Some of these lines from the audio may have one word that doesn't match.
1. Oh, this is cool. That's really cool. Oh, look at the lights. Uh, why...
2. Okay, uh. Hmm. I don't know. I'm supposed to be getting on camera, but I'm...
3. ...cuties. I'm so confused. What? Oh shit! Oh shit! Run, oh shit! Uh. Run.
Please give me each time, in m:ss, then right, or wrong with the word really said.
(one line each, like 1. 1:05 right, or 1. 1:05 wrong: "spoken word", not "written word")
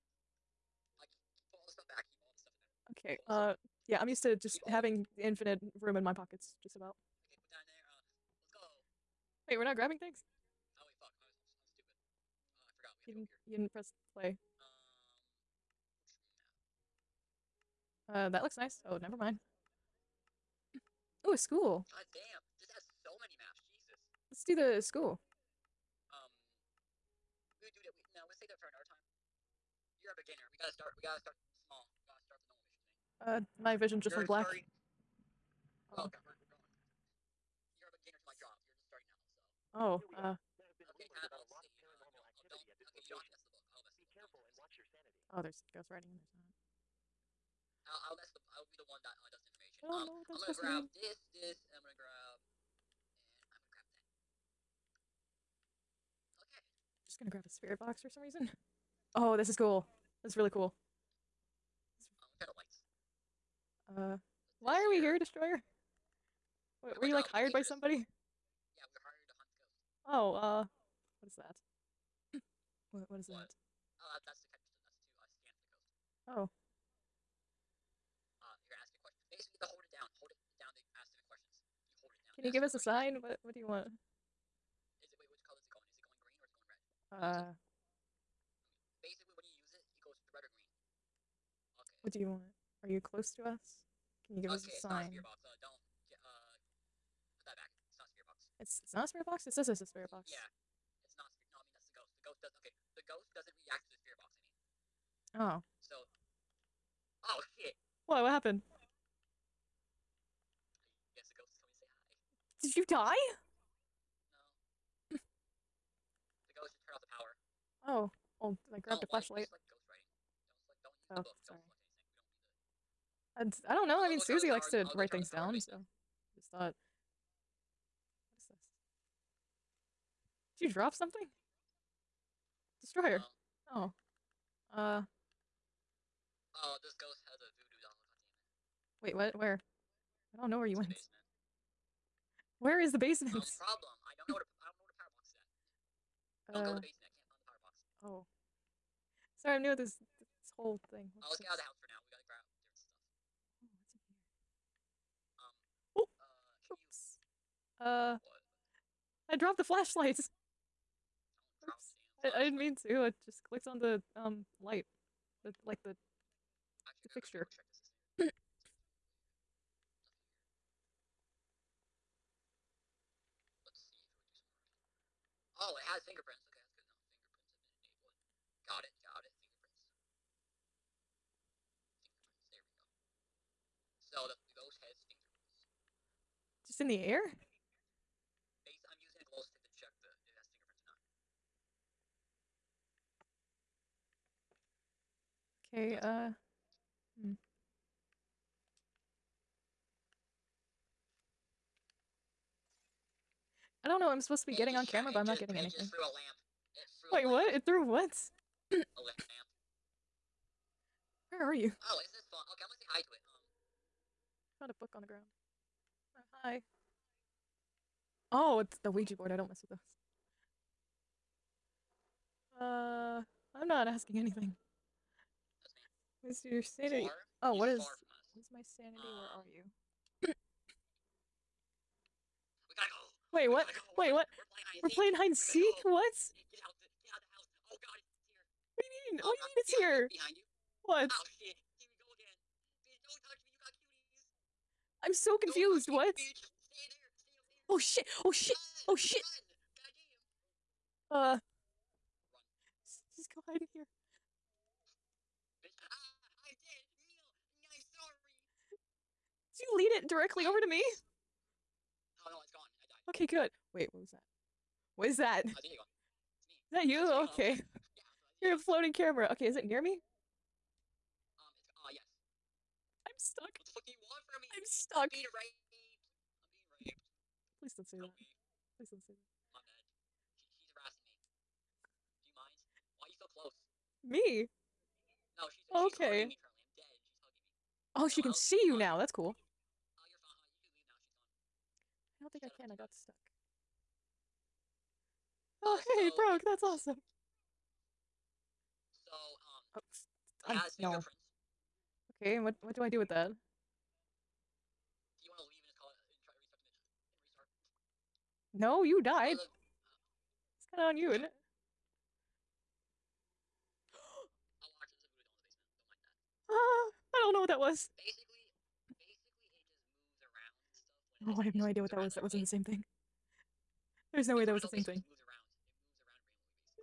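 1. 0:59 right
2. 3:15 right
3. 4:03 right.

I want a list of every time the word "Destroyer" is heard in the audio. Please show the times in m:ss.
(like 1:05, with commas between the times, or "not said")
1:05, 2:12.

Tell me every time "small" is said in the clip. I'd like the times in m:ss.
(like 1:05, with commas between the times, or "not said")
0:31.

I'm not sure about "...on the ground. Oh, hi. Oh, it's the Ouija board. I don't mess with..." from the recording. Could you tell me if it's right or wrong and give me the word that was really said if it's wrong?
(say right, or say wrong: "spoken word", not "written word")
right.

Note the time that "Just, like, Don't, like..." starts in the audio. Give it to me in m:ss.
1:59.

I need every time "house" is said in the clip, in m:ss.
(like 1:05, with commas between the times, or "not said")
2:31, 3:57.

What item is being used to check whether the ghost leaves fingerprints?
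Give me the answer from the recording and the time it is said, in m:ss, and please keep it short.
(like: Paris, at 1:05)
Glow stick, at 3:09.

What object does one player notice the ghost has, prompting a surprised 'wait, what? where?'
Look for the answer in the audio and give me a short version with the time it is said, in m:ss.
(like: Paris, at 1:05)
Voodoo doll, at 2:17.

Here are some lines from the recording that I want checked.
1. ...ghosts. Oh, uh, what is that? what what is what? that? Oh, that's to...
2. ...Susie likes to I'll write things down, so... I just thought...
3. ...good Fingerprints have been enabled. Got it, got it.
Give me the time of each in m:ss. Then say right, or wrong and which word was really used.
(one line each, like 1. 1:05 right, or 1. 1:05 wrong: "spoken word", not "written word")
1. 1:09 right
2. 2:04 right
3. 2:56 right.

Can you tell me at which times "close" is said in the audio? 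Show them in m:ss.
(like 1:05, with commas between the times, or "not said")
1:32, 4:43.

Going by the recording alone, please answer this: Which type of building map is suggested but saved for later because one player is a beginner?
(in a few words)
A school.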